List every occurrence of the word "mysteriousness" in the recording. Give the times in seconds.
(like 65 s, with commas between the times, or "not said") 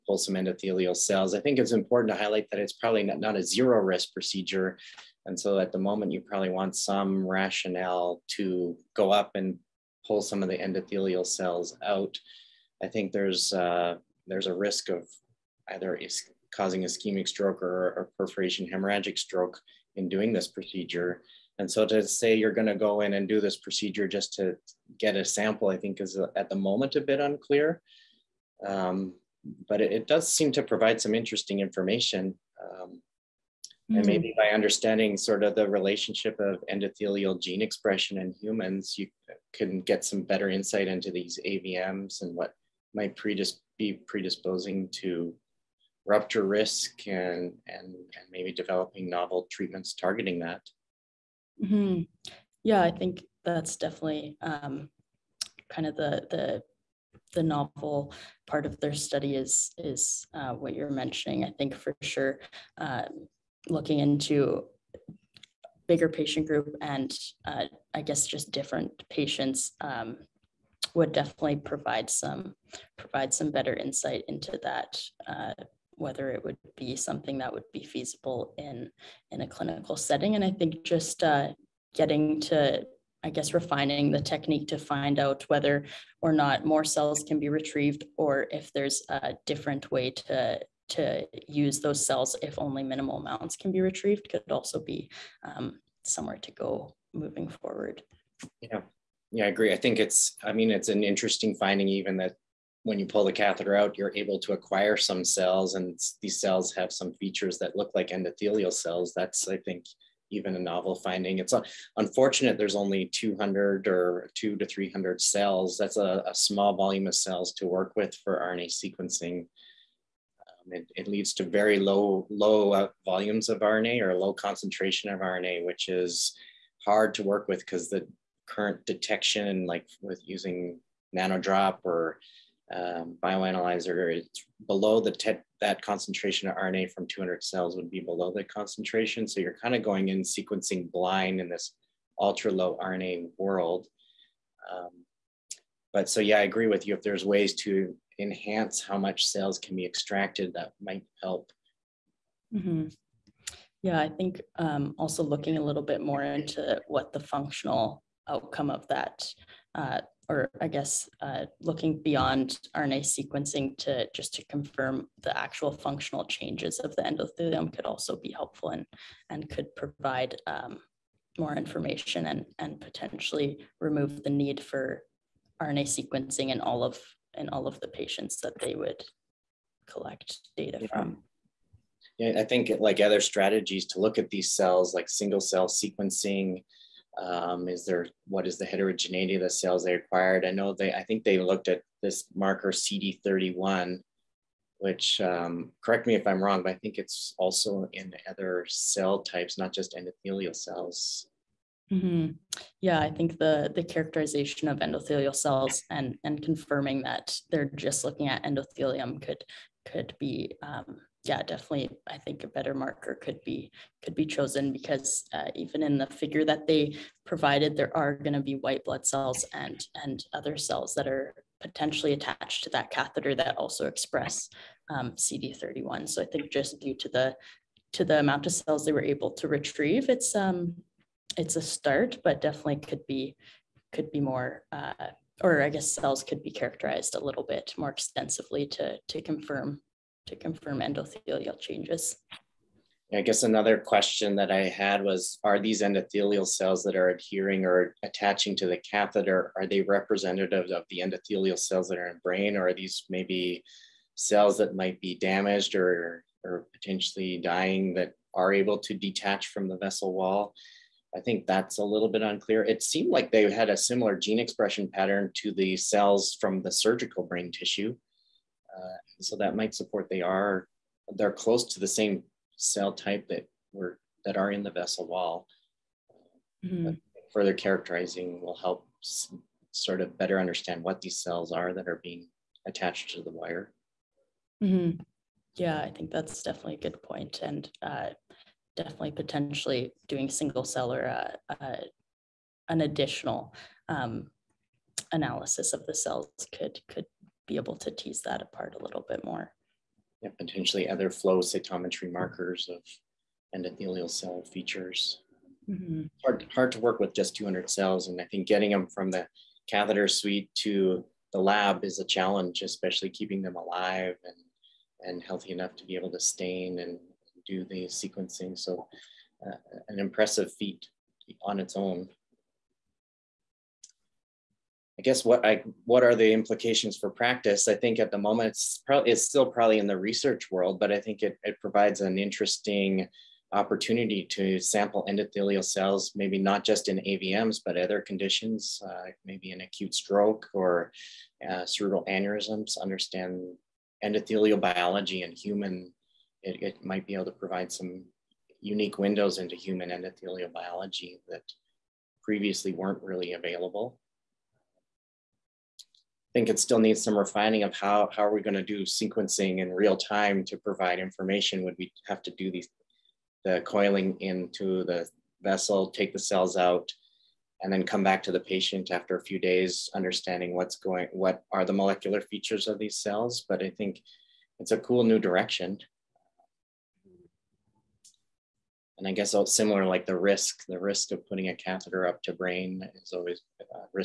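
not said.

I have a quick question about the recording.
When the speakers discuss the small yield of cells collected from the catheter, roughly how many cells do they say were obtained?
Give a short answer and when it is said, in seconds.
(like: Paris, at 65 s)
200 to 300, at 114 s.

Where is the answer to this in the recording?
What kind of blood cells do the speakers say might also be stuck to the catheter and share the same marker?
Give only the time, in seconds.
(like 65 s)
218 s.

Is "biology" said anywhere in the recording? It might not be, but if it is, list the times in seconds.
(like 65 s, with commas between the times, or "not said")
344 s, 350 s.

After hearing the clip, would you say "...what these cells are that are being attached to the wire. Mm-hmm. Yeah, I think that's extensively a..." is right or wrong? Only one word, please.
wrong.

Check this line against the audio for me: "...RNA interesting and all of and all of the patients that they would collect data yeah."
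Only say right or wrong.
wrong.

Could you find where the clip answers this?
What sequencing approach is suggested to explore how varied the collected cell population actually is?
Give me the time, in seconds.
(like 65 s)
185 s.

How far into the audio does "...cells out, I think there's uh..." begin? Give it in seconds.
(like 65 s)
11 s.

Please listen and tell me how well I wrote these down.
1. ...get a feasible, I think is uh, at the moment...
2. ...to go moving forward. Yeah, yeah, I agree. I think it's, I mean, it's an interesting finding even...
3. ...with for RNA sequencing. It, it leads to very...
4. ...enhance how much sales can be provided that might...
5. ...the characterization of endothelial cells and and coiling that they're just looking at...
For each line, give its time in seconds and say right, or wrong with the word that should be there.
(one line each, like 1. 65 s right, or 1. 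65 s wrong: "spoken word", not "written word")
1. 24 s wrong: "sample", not "feasible"
2. 96 s right
3. 117 s right
4. 148 s wrong: "extracted", not "provided"
5. 203 s wrong: "confirming", not "coiling".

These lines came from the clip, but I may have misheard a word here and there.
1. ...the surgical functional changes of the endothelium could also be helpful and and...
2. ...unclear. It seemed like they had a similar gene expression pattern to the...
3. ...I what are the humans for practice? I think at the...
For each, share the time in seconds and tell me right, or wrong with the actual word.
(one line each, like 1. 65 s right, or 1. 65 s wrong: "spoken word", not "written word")
1. 165 s wrong: "actual", not "surgical"
2. 262 s right
3. 325 s wrong: "implications", not "humans".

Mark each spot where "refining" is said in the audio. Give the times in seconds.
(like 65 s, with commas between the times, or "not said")
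83 s, 357 s.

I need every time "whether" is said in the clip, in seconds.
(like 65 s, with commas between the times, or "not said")
75 s, 85 s.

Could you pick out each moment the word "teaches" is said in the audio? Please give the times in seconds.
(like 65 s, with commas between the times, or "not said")
not said.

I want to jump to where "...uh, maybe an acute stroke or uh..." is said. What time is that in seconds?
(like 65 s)
338 s.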